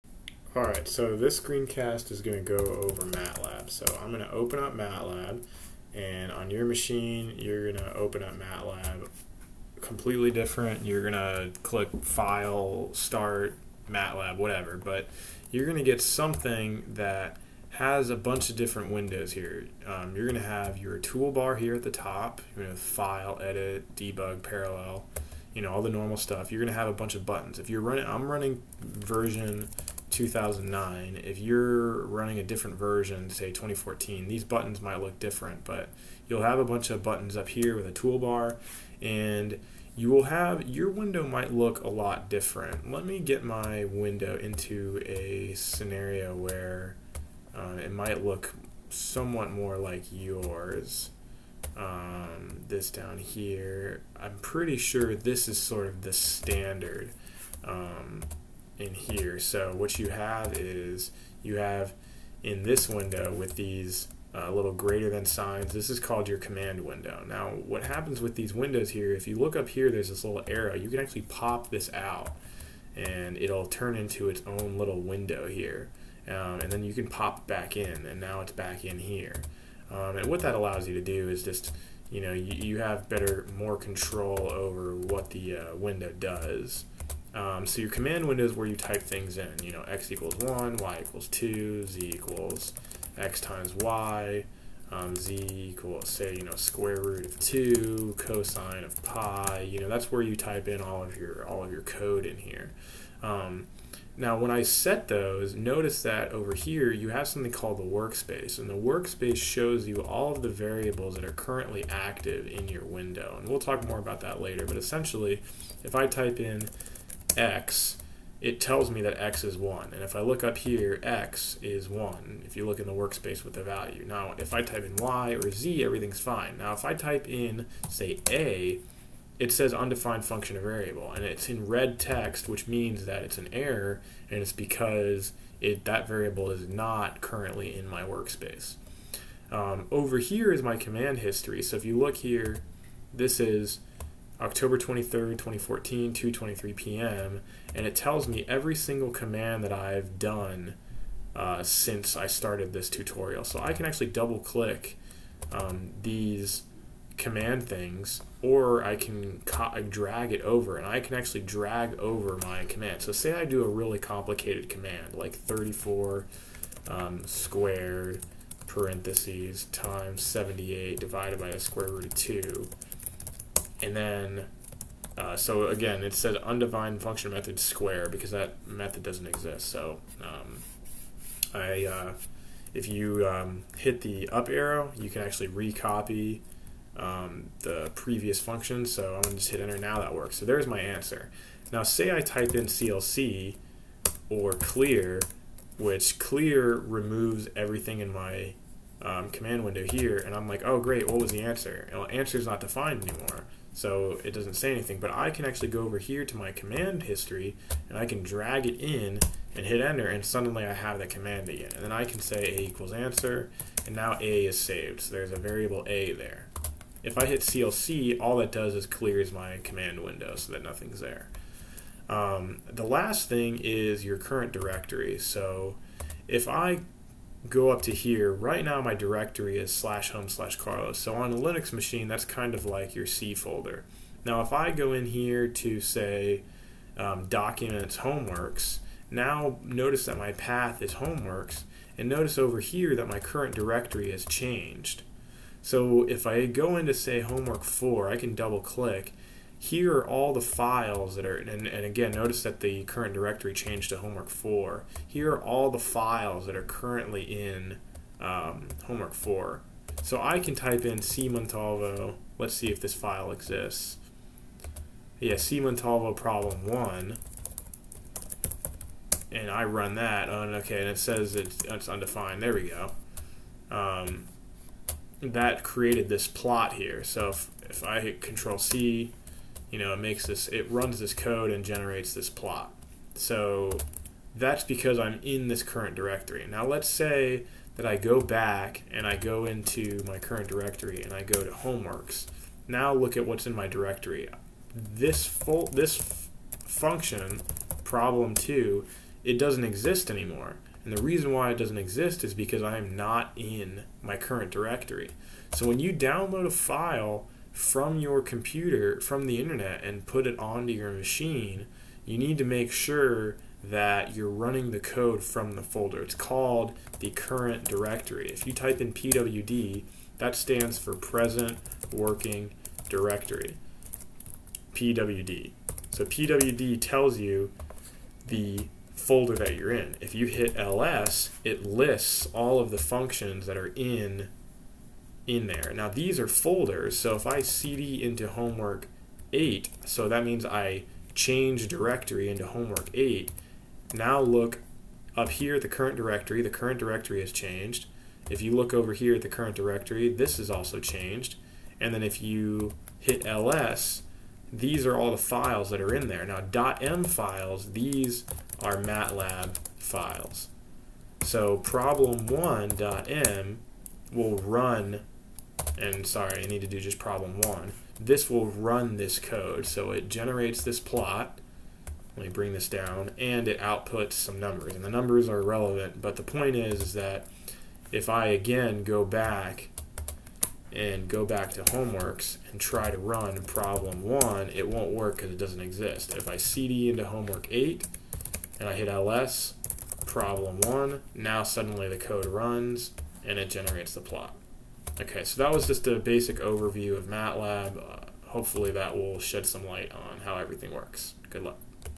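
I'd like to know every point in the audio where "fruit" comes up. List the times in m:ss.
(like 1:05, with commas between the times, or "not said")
not said.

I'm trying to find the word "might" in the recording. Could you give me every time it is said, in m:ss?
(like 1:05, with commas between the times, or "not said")
0:34, 0:41, 0:47.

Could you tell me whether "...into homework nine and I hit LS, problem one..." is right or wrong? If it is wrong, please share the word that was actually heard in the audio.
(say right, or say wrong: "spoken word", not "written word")
wrong: "eight", not "nine".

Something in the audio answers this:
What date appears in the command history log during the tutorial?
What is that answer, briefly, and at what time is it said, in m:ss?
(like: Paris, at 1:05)
October 23rd, 2014, at 2:24.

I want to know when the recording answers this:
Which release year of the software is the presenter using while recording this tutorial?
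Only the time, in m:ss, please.
0:28.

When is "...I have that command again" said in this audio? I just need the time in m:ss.
3:30.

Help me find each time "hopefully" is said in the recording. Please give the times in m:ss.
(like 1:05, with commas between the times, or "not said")
6:38.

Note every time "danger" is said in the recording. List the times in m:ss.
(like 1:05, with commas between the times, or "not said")
not said.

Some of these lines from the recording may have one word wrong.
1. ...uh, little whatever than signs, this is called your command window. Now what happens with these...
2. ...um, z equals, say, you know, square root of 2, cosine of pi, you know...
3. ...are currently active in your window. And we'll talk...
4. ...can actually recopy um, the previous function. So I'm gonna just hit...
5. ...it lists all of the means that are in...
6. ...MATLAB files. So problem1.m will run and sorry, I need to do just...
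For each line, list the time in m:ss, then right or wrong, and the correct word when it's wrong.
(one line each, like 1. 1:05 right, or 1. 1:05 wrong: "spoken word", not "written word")
1. 1:04 wrong: "greater", not "whatever"
2. 1:34 right
3. 1:51 right
4. 3:05 right
5. 5:31 wrong: "functions", not "means"
6. 5:58 right.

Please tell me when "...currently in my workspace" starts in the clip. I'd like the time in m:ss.
2:17.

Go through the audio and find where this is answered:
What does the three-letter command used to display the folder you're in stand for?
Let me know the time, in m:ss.
5:20.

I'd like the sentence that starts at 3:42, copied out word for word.
Um, the last thing is your current directory.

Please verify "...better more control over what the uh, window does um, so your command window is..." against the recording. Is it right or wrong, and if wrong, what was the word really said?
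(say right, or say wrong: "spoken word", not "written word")
right.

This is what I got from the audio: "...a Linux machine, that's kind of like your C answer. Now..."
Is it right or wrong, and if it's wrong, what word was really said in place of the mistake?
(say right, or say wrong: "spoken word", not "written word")
wrong: "folder", not "answer".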